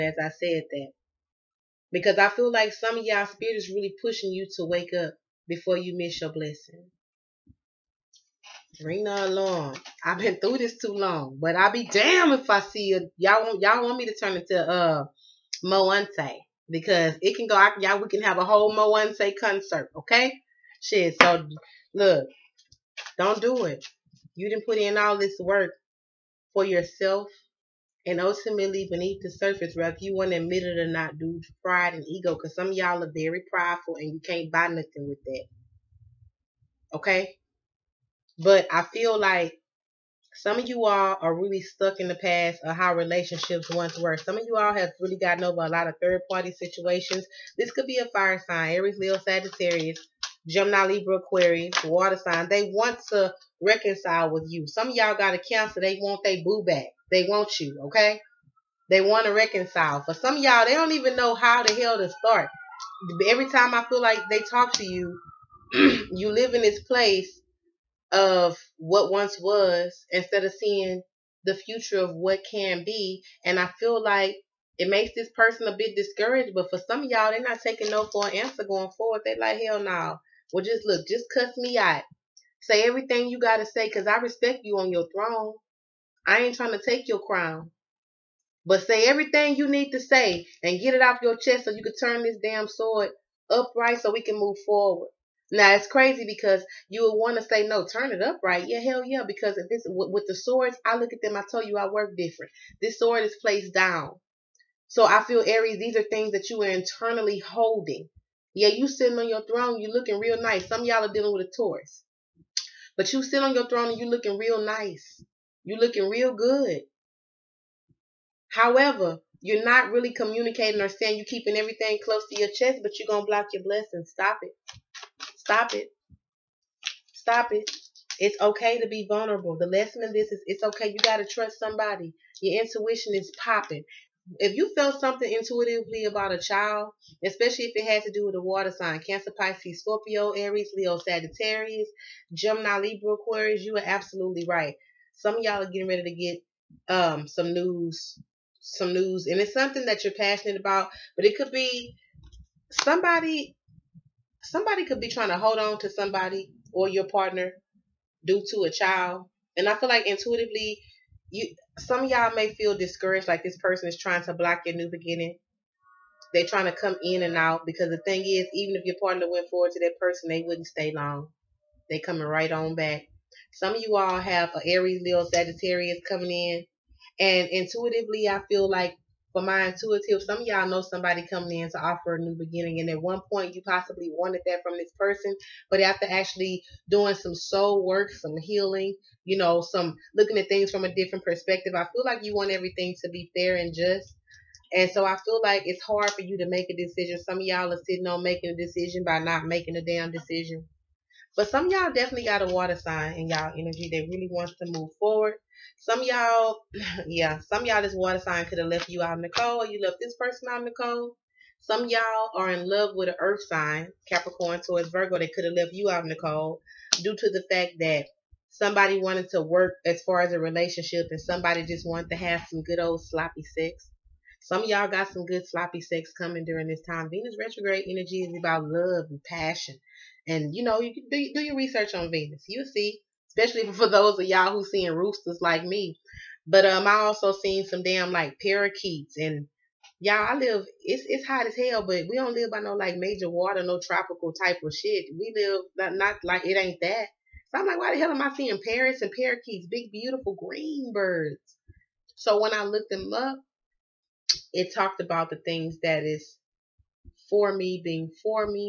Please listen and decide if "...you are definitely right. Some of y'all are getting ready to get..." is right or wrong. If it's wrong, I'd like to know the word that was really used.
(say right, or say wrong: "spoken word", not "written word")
wrong: "absolutely", not "definitely".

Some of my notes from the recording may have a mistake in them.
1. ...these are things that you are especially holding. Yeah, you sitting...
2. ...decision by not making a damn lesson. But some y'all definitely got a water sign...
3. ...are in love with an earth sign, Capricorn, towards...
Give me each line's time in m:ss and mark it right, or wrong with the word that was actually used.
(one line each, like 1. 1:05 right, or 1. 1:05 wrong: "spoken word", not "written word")
1. 1:45 wrong: "internally", not "especially"
2. 3:18 wrong: "decision", not "lesson"
3. 3:32 right.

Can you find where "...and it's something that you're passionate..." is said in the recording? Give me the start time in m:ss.
2:29.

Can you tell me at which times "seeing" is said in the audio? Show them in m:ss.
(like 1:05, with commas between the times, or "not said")
1:10, 3:54, 4:08.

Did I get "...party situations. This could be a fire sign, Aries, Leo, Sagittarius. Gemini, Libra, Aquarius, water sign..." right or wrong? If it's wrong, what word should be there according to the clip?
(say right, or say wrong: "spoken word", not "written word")
right.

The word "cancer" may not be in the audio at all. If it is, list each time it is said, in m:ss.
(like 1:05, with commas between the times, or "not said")
0:55, 2:18.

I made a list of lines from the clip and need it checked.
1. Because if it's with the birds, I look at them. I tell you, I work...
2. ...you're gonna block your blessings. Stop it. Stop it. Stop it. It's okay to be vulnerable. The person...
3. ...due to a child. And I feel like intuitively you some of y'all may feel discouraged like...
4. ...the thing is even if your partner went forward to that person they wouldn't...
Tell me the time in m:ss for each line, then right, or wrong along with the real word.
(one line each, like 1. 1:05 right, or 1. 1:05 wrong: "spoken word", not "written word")
1. 1:39 wrong: "swords", not "birds"
2. 2:02 wrong: "lesson", not "person"
3. 2:38 right
4. 2:47 right.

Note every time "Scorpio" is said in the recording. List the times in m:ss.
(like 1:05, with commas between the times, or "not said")
2:19.